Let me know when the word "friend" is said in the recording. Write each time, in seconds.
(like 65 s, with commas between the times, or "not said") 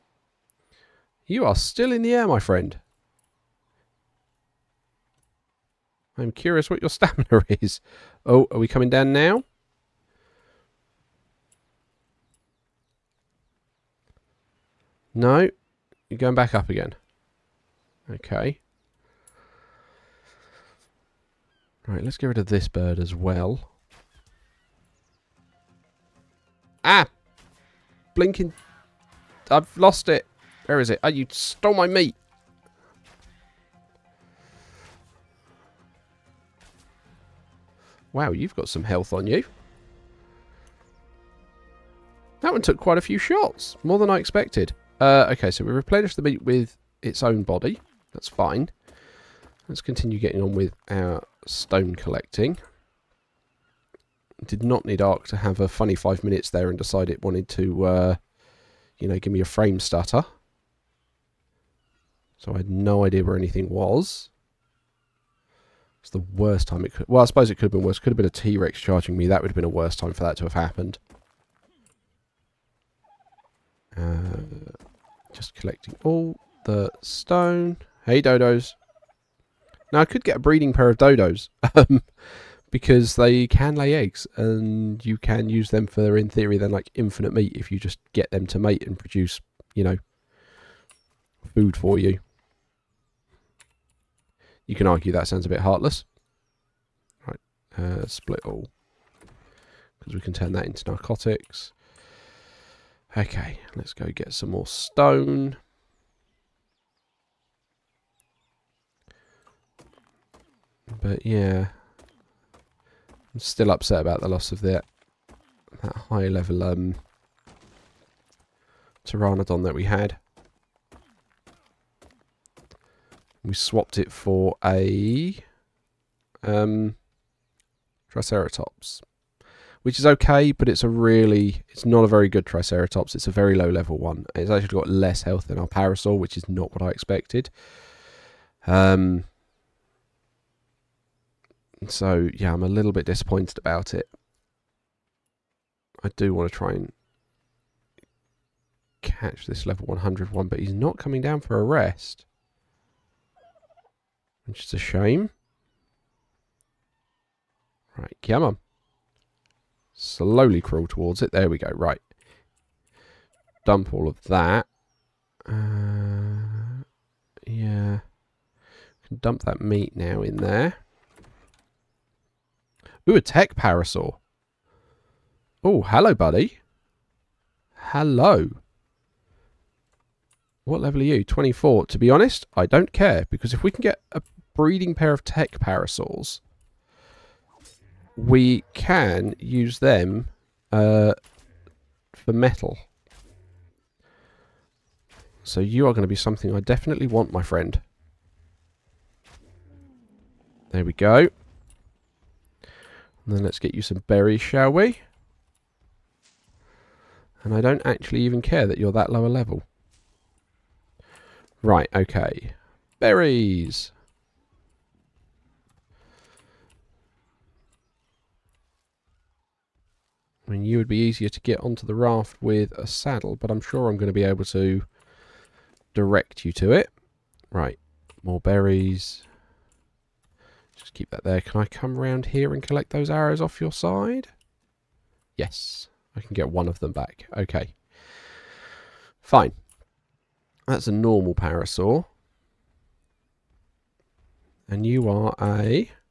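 2 s, 197 s.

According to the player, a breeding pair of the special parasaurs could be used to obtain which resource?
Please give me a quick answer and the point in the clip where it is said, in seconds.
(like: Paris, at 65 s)
Metal, at 192 s.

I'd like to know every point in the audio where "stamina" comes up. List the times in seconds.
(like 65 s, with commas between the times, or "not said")
6 s.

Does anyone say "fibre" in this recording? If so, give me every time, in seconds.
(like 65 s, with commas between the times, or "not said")
not said.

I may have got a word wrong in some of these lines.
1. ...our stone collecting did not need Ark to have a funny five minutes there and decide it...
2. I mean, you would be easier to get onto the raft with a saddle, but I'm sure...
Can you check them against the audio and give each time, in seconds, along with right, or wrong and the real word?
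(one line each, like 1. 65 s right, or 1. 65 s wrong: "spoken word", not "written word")
1. 50 s right
2. 220 s right.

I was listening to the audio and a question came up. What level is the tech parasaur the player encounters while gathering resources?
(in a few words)
24.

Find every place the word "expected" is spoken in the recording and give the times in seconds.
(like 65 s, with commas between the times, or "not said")
44 s, 136 s.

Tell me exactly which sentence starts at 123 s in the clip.
We swapped it for a um, Triceratops.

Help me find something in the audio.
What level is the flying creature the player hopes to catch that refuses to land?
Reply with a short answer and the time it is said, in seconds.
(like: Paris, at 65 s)
100, at 149 s.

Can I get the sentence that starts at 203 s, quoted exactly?
And then let's get you some berries, shall we?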